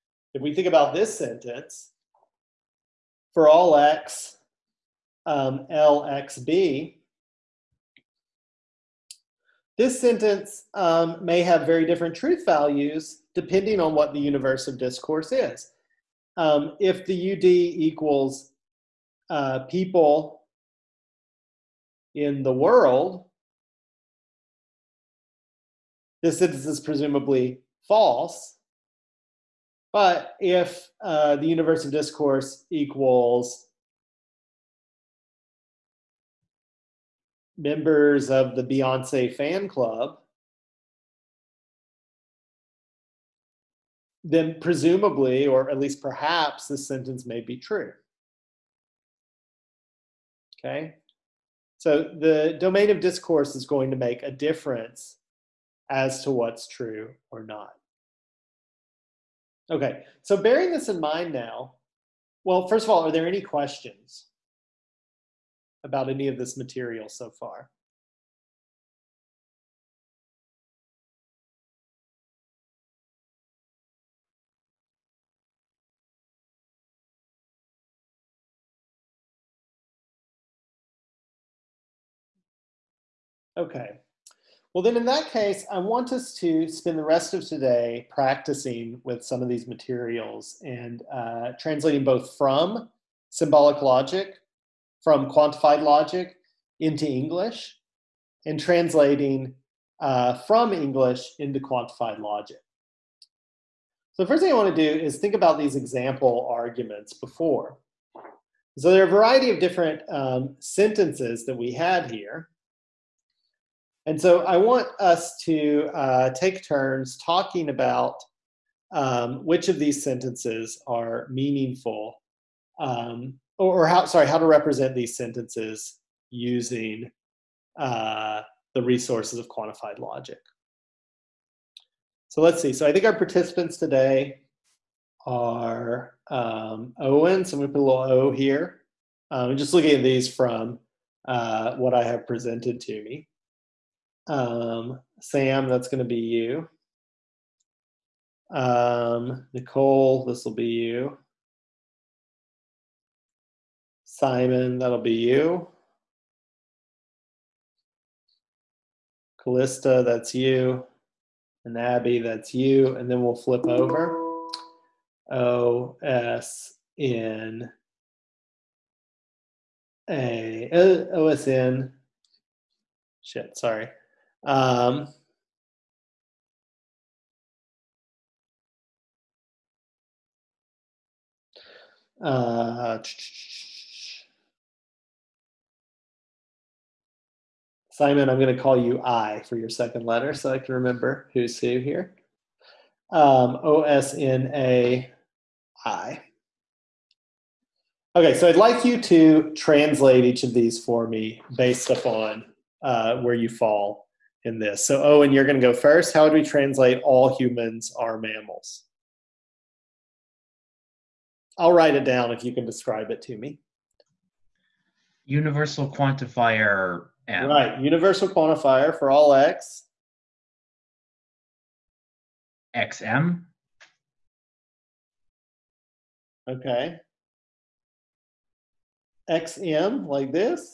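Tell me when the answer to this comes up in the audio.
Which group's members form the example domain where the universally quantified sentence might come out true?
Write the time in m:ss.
0:38.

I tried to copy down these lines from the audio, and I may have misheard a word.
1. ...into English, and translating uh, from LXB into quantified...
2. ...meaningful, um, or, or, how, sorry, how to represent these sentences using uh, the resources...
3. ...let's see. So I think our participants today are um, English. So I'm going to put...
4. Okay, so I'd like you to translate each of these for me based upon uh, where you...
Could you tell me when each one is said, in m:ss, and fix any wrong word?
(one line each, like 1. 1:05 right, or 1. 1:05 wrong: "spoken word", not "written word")
1. 1:36 wrong: "English", not "LXB"
2. 2:01 right
3. 2:12 wrong: "Owen", not "English"
4. 3:18 right.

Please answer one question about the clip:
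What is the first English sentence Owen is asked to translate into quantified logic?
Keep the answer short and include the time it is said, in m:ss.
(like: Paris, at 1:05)
All humans are mammals, at 3:27.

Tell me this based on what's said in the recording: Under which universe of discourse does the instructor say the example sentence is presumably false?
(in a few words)
people in the world.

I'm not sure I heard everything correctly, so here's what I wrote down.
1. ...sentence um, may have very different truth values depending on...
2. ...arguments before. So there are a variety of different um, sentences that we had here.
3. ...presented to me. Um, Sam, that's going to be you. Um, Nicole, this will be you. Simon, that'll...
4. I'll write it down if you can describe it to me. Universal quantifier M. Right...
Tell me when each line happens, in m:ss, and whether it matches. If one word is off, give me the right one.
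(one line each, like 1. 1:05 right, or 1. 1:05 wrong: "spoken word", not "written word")
1. 0:09 right
2. 1:46 right
3. 2:22 right
4. 3:31 right.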